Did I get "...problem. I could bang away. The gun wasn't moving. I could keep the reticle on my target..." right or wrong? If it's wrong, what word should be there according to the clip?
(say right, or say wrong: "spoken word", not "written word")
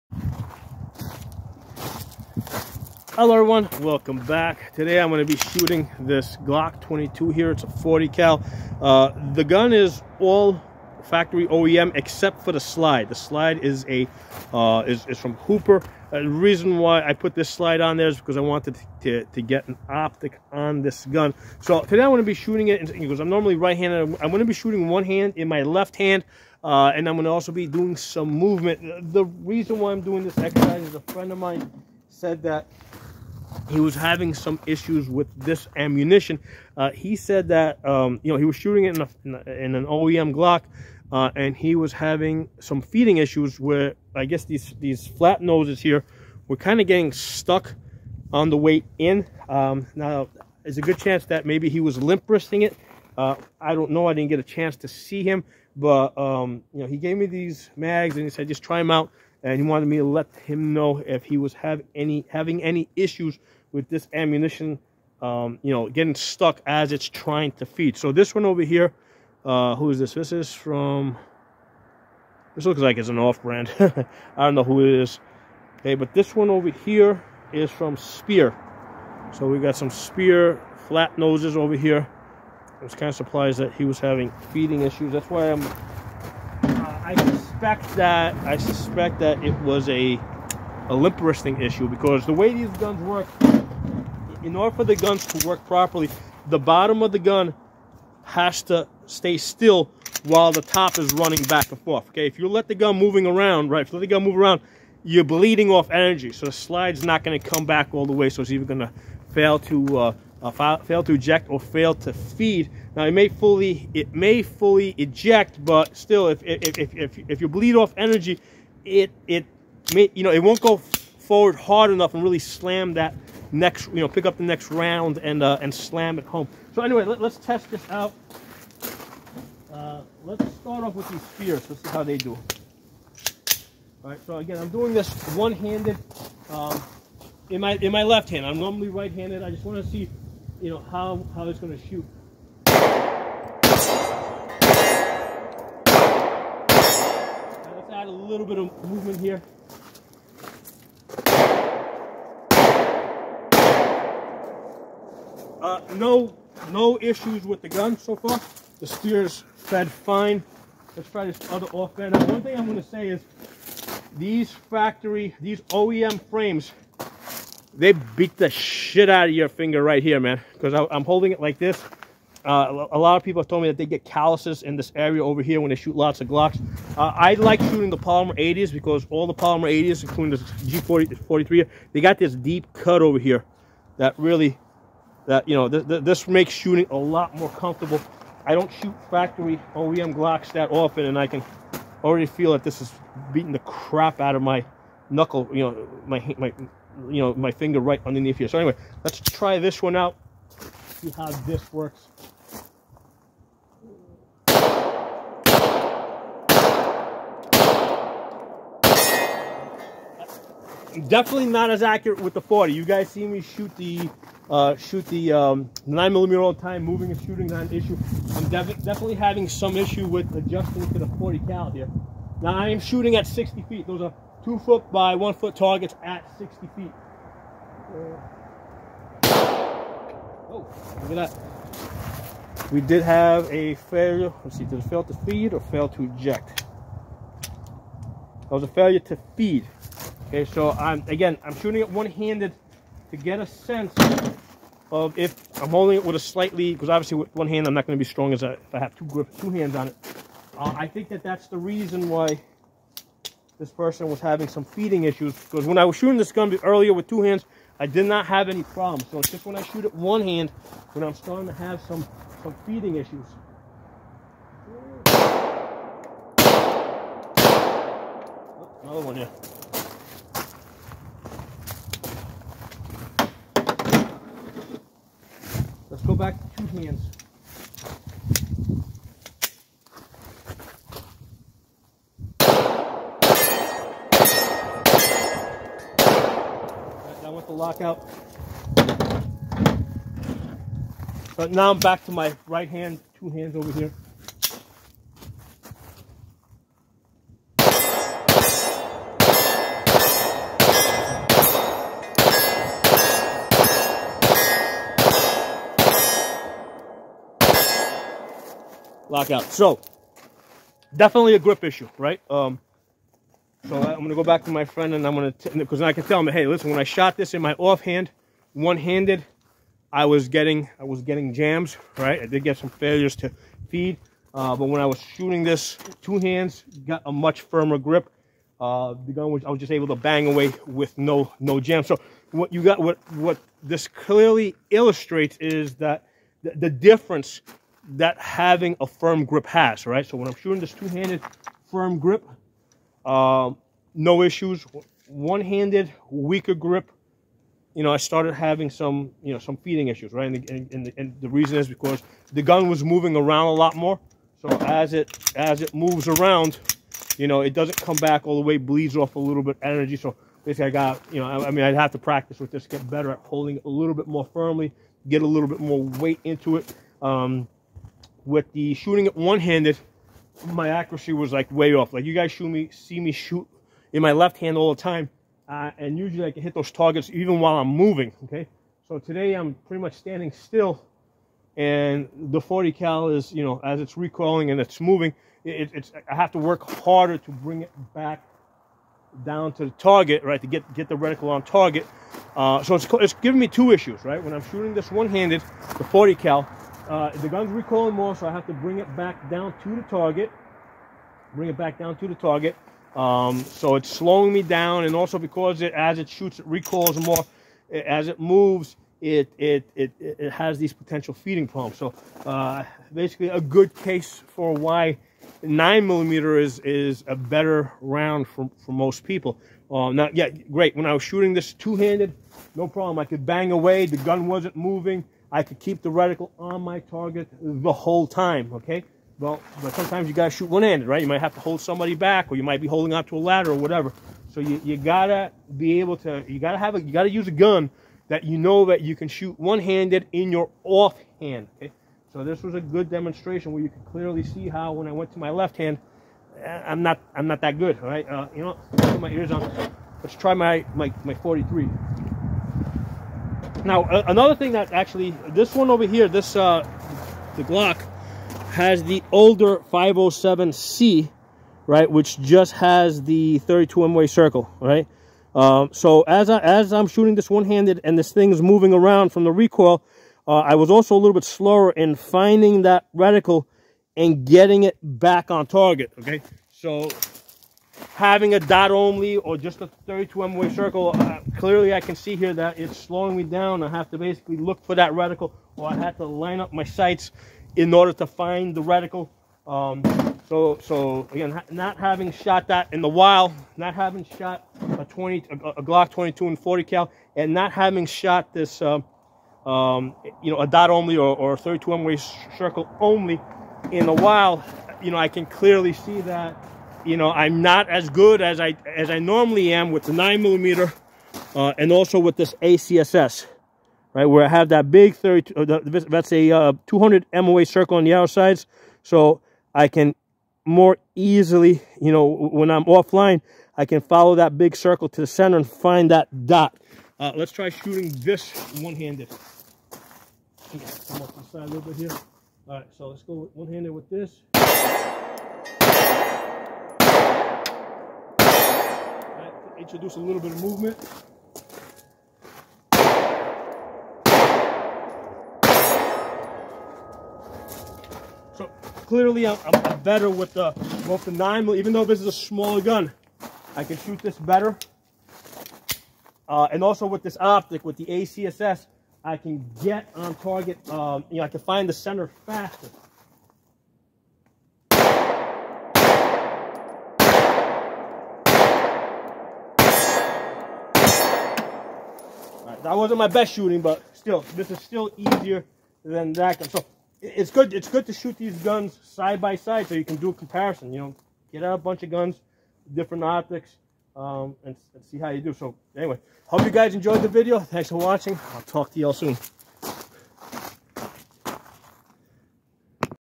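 right.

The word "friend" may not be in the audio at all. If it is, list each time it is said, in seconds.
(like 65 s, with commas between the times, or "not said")
31 s, 314 s.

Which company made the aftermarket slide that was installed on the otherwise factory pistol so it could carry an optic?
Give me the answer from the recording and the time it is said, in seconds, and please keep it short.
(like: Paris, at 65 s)
Hooper, at 15 s.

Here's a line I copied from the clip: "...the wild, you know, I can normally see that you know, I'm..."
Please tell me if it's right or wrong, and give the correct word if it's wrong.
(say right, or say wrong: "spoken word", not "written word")
wrong: "clearly", not "normally".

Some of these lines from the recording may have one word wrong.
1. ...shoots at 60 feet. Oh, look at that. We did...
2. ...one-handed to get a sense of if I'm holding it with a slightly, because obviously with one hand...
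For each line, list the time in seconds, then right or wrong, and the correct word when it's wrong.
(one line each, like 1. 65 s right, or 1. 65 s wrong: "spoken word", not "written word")
1. 225 s wrong: "targets", not "shoots"
2. 241 s right.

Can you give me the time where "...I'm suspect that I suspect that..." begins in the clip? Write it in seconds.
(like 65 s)
85 s.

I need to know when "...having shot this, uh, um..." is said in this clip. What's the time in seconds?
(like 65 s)
497 s.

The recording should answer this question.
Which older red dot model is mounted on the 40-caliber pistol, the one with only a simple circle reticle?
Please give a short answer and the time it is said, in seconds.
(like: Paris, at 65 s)
507C, at 459 s.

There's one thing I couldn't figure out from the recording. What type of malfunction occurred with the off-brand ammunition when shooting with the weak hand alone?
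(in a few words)
Failure to feed.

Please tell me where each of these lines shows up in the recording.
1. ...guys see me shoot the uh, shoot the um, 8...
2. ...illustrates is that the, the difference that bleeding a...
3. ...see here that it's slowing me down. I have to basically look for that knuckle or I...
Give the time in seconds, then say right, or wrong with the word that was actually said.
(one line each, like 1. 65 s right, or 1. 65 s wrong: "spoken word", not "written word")
1. 212 s wrong: "9", not "8"
2. 334 s wrong: "having", not "bleeding"
3. 481 s wrong: "reticle", not "knuckle".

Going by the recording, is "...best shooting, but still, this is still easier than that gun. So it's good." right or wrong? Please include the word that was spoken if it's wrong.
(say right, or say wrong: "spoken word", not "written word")
right.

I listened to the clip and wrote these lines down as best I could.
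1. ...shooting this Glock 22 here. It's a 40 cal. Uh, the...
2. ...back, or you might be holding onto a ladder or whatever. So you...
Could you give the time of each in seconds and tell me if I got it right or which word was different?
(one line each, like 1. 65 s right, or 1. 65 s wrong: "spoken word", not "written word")
1. 5 s right
2. 431 s right.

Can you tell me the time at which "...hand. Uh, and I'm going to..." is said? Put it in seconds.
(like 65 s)
25 s.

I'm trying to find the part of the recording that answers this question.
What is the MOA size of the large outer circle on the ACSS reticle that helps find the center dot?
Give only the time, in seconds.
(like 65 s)
516 s.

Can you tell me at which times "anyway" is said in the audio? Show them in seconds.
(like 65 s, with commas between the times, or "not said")
126 s, 198 s, 585 s.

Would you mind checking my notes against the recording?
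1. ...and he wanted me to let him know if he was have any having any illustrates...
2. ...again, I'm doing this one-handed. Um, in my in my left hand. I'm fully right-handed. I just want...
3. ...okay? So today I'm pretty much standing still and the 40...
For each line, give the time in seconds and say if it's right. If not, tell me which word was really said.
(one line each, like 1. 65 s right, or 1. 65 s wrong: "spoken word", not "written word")
1. 59 s wrong: "issues", not "illustrates"
2. 134 s wrong: "normally", not "fully"
3. 378 s right.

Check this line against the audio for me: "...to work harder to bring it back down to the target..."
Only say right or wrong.
right.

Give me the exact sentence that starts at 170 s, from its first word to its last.
Because I'm holding it like this.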